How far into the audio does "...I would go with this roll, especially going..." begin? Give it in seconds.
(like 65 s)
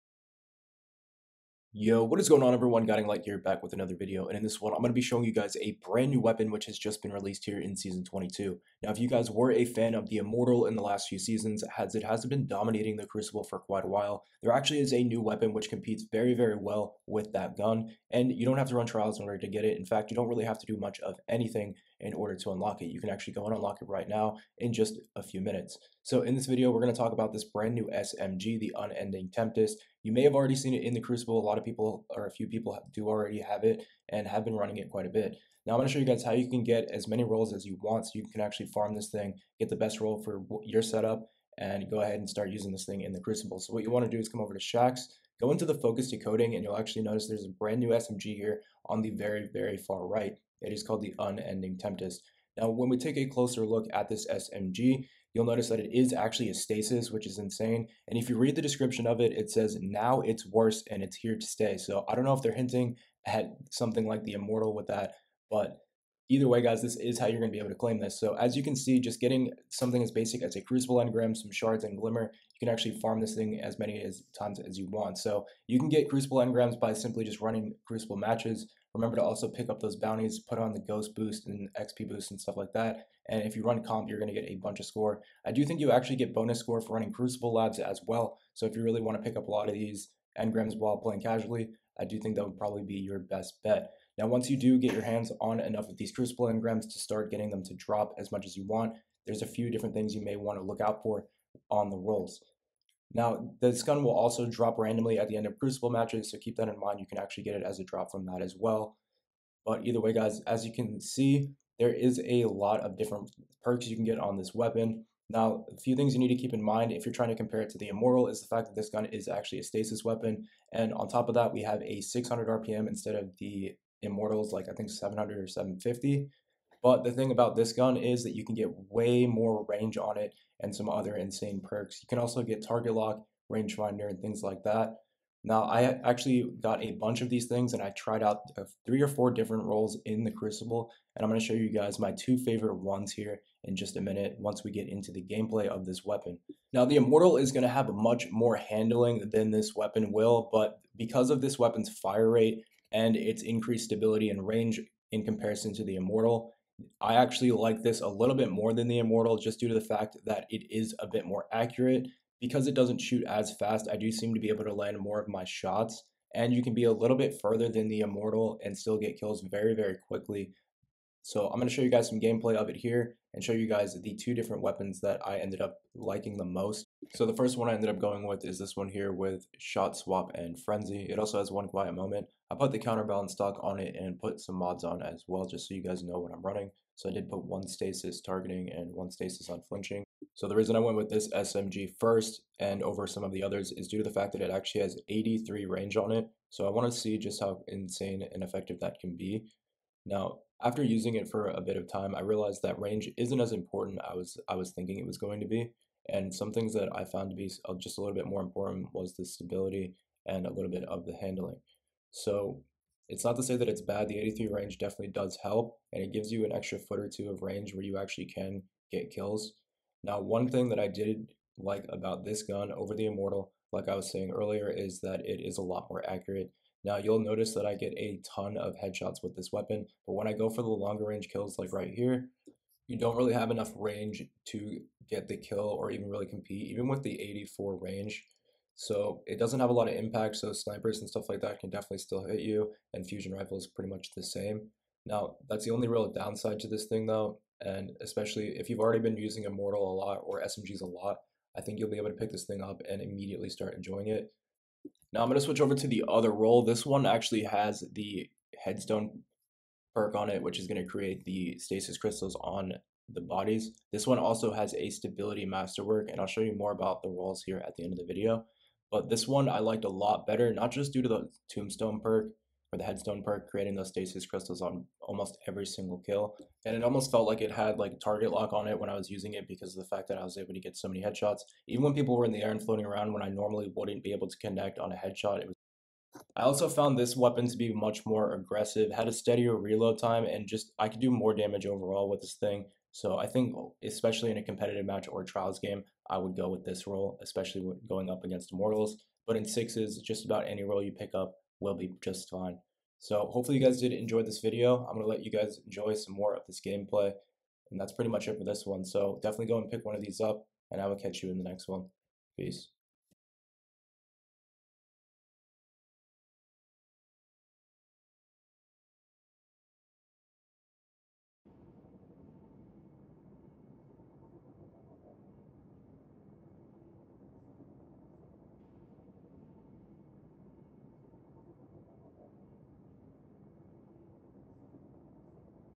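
296 s.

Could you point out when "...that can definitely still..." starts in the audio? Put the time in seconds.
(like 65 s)
241 s.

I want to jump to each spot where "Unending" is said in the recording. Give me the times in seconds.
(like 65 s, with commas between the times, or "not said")
28 s, 51 s.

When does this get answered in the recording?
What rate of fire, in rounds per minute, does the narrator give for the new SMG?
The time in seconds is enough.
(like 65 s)
122 s.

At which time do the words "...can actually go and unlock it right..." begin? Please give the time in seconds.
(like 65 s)
22 s.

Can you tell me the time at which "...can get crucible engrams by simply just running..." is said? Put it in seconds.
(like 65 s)
75 s.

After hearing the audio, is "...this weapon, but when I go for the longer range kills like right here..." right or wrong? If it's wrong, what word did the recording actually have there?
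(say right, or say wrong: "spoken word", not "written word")
right.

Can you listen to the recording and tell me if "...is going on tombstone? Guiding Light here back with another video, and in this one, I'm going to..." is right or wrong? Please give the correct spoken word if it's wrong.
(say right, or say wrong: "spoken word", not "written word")
wrong: "everyone", not "tombstone".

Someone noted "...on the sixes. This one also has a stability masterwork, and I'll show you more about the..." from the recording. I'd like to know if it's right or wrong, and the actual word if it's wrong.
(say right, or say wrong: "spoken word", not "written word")
wrong: "bodies", not "sixes".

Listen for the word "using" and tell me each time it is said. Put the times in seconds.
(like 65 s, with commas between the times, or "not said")
42 s, 200 s, 249 s, 279 s.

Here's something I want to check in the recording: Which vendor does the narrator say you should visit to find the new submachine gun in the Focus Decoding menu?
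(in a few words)
Shaxx.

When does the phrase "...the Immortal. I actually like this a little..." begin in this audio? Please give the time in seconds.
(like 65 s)
155 s.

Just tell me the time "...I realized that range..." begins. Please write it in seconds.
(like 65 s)
202 s.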